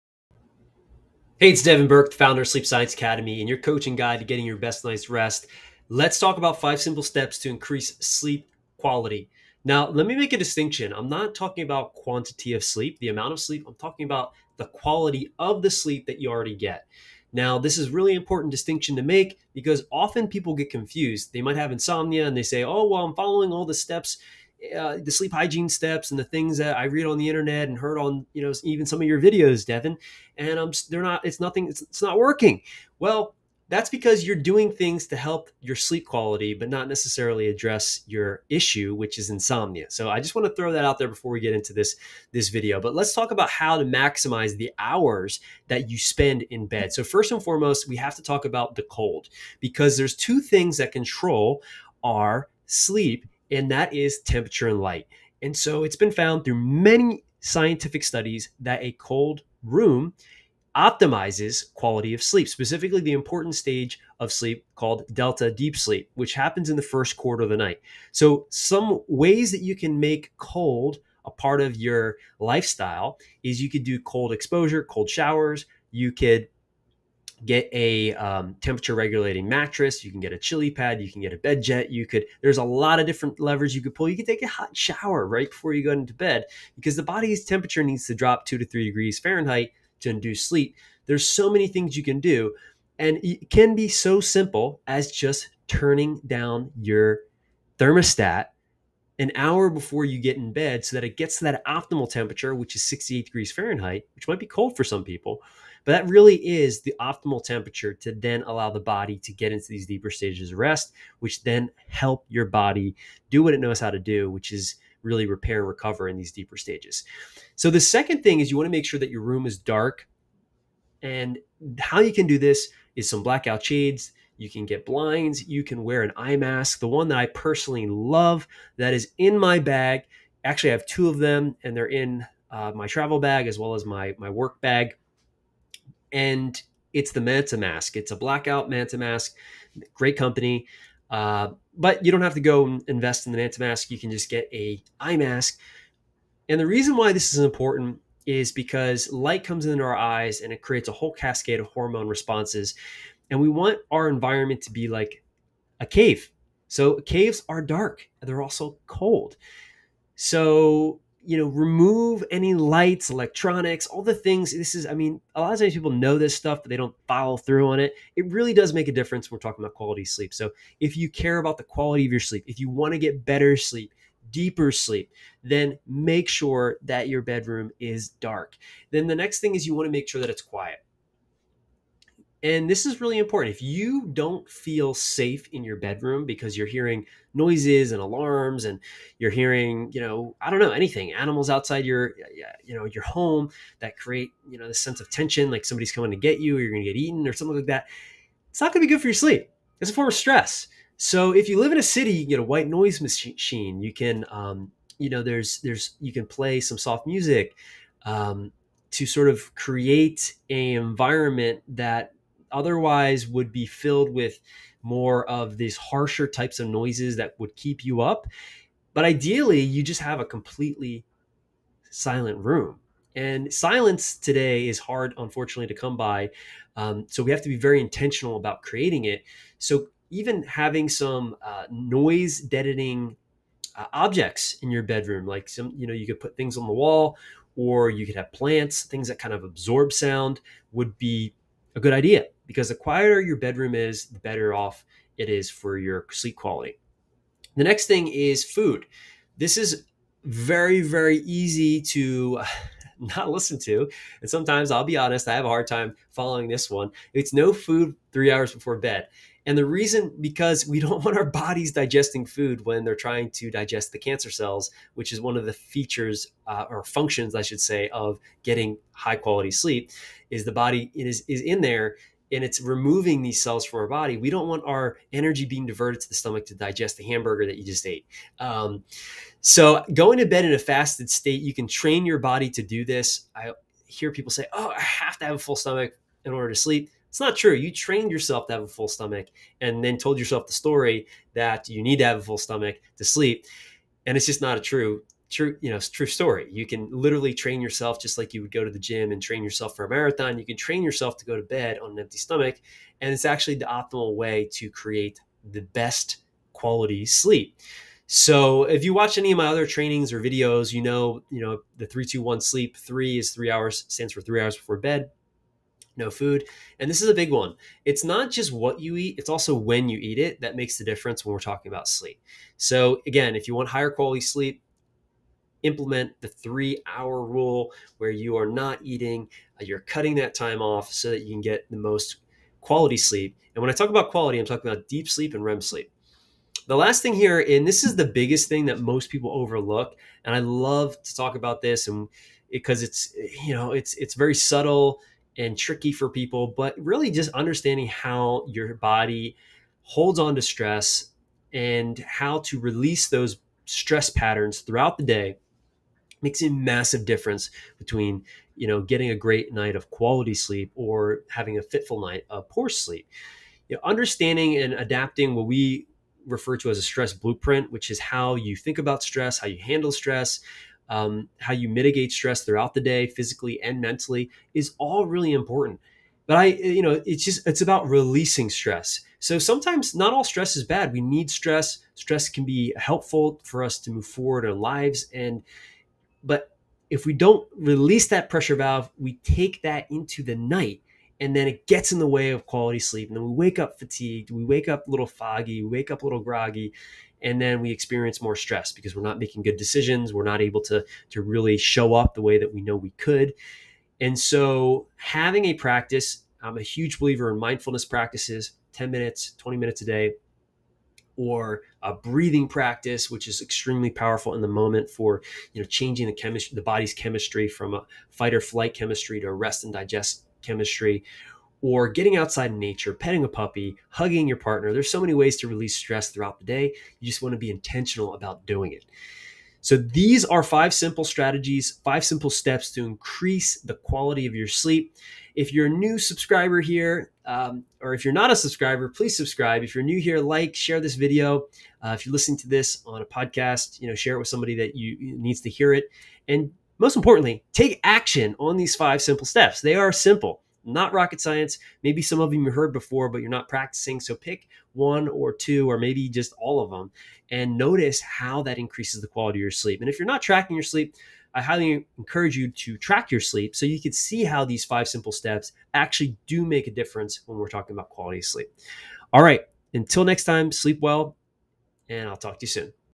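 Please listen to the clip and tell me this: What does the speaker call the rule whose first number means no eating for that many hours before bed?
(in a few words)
321 sleep.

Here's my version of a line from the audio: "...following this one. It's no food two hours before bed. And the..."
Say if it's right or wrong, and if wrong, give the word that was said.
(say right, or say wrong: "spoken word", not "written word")
wrong: "three", not "two".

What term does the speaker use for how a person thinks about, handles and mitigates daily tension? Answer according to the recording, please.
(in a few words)
Stress blueprint.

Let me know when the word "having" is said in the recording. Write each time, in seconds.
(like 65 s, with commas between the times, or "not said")
230 s, 361 s, 404 s.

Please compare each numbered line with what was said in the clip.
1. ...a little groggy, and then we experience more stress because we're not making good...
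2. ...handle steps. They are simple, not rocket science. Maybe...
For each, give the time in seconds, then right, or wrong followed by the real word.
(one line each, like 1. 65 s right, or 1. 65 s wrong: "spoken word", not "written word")
1. 396 s right
2. 449 s wrong: "simple", not "handle".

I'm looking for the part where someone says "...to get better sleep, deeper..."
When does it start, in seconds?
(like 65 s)
172 s.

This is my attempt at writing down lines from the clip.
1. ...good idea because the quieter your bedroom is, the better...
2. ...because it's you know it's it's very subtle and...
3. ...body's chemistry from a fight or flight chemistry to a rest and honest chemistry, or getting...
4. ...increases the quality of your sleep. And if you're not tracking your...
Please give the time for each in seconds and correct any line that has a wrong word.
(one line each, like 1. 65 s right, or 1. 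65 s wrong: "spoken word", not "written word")
1. 241 s right
2. 342 s right
3. 416 s wrong: "digest", not "honest"
4. 458 s right.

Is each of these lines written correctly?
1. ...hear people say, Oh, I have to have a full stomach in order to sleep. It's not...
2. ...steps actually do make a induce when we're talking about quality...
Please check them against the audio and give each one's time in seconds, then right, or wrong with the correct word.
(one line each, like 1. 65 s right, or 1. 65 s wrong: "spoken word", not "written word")
1. 283 s right
2. 465 s wrong: "difference", not "induce".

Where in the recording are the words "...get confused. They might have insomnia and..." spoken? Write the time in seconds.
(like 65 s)
20 s.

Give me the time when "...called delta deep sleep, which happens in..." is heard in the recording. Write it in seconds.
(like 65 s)
64 s.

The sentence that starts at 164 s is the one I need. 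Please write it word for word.
This is, I mean, a lot of times people know this stuff, but they don't follow through on it.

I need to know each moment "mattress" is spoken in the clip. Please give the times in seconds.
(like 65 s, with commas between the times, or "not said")
79 s.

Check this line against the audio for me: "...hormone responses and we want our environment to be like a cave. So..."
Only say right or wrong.
right.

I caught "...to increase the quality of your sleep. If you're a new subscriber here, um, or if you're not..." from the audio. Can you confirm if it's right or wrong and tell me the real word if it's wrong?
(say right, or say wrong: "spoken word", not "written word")
right.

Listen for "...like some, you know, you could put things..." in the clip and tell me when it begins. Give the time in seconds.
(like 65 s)
235 s.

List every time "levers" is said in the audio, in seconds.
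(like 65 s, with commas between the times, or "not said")
83 s.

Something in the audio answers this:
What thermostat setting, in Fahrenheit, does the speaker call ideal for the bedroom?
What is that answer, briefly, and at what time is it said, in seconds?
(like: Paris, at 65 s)
68 degrees, at 102 s.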